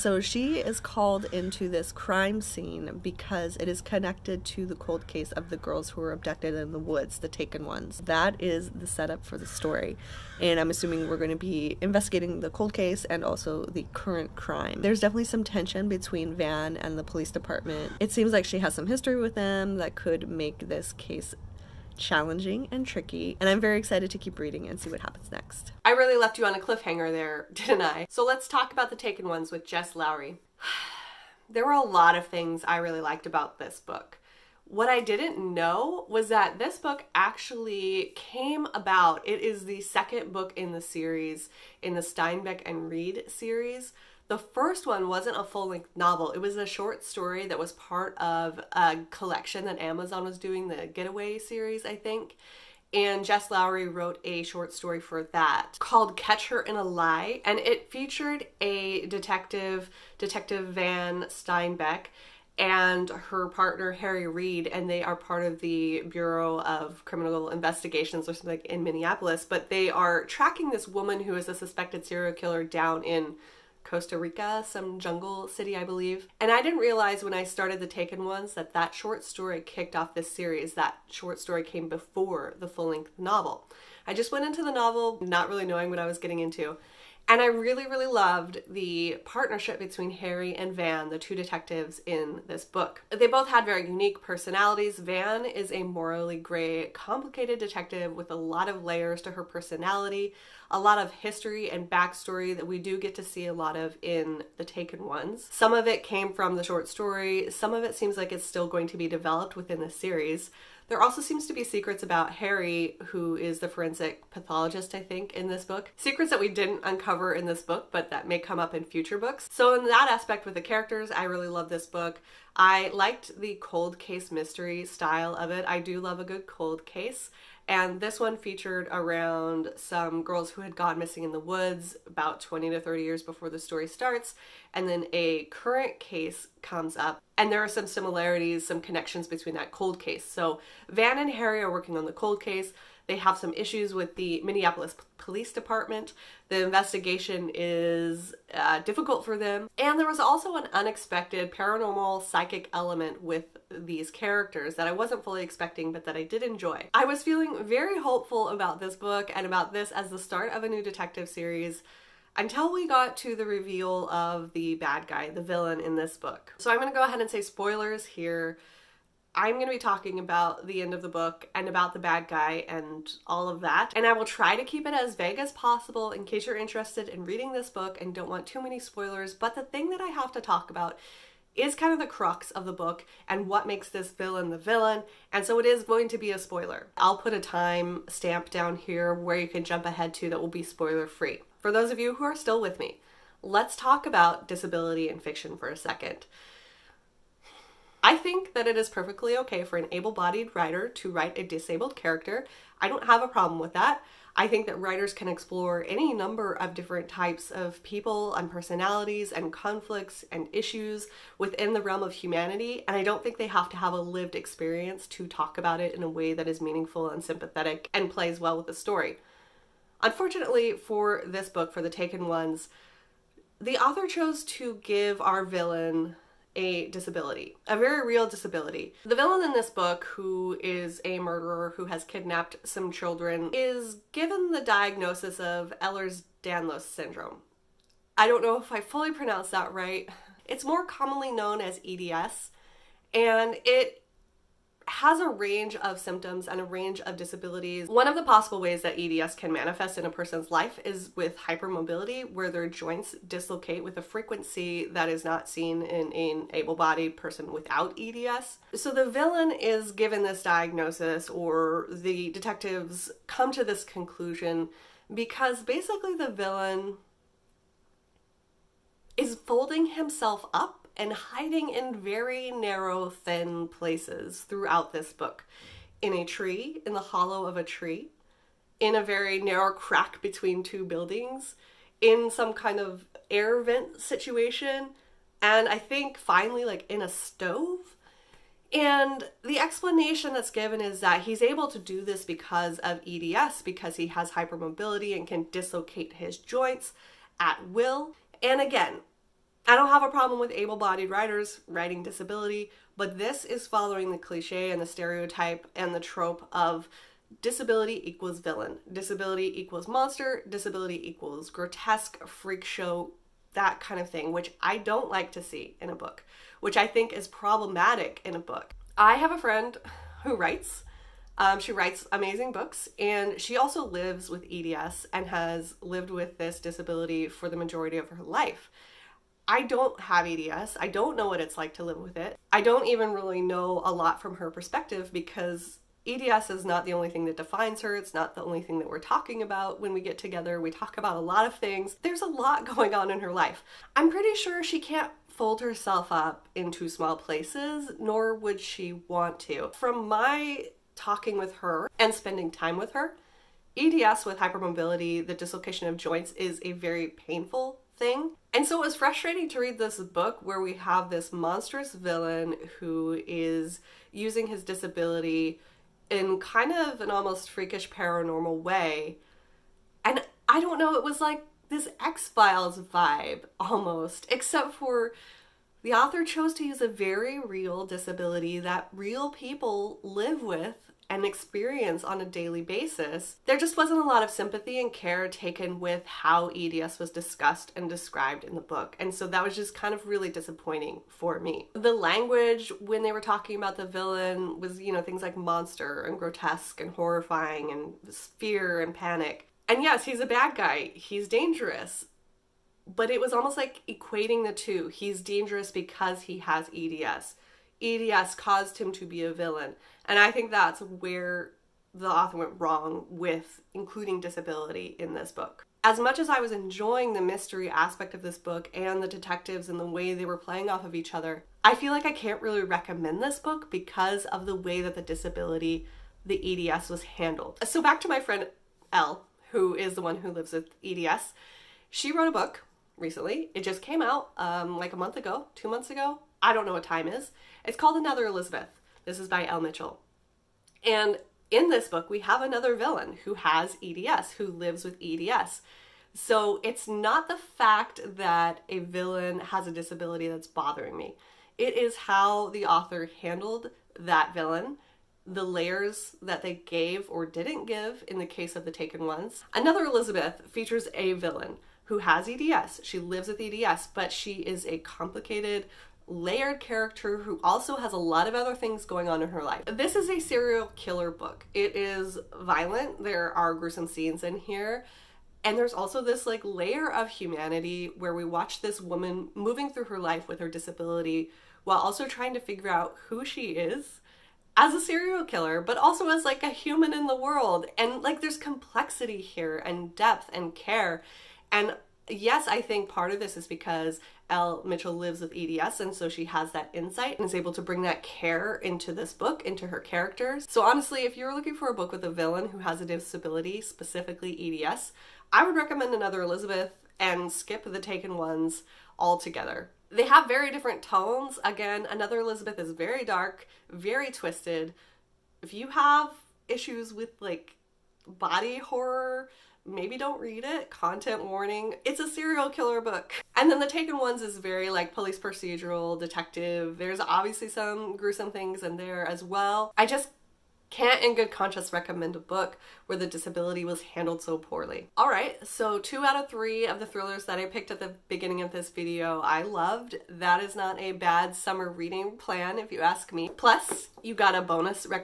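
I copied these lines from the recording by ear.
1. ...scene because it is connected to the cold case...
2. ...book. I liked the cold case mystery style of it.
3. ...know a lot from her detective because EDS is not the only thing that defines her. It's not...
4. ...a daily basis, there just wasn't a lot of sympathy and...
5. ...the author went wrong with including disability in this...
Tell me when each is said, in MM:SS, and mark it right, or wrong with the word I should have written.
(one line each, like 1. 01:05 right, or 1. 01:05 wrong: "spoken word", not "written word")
1. 00:02 right
2. 02:01 right
3. 05:33 wrong: "perspective", not "detective"
4. 06:22 right
5. 06:51 right.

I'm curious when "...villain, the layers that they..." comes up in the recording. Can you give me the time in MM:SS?
07:34.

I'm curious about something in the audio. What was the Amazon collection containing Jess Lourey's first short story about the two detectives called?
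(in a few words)
the Getaway series.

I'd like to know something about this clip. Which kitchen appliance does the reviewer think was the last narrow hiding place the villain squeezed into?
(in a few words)
a stove.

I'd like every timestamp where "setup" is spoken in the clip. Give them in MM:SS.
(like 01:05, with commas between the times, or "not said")
00:08.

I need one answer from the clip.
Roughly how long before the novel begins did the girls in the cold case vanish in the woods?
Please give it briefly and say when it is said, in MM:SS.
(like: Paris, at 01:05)
20 to 30 years, at 02:12.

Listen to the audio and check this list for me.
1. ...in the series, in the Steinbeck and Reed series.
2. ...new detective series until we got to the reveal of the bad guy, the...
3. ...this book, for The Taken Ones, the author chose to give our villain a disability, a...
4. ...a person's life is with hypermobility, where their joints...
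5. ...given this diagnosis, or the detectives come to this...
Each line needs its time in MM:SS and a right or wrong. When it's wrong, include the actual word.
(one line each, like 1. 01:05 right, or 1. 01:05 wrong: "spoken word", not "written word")
1. 00:40 right
2. 02:40 right
3. 03:41 right
4. 04:10 right
5. 04:19 right.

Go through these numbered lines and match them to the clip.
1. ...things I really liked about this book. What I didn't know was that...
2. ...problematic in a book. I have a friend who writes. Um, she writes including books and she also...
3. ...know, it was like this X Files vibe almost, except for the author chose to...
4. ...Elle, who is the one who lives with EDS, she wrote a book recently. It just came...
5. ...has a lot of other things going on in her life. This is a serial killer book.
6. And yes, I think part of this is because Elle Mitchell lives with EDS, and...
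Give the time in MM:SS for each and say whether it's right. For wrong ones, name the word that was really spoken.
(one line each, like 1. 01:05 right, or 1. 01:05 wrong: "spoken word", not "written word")
1. 00:32 right
2. 05:17 wrong: "amazing", not "including"
3. 06:10 right
4. 07:08 right
5. 07:47 right
6. 08:11 right.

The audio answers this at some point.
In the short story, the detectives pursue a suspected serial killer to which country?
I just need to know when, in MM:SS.
01:13.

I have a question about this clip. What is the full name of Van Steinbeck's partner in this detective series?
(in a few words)
Harry Reed.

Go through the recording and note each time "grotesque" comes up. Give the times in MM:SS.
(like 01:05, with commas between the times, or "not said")
05:11, 06:36.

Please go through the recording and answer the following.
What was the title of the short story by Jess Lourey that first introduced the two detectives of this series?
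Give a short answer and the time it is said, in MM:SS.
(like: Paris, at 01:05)
Catch Her in a Lie, at 00:56.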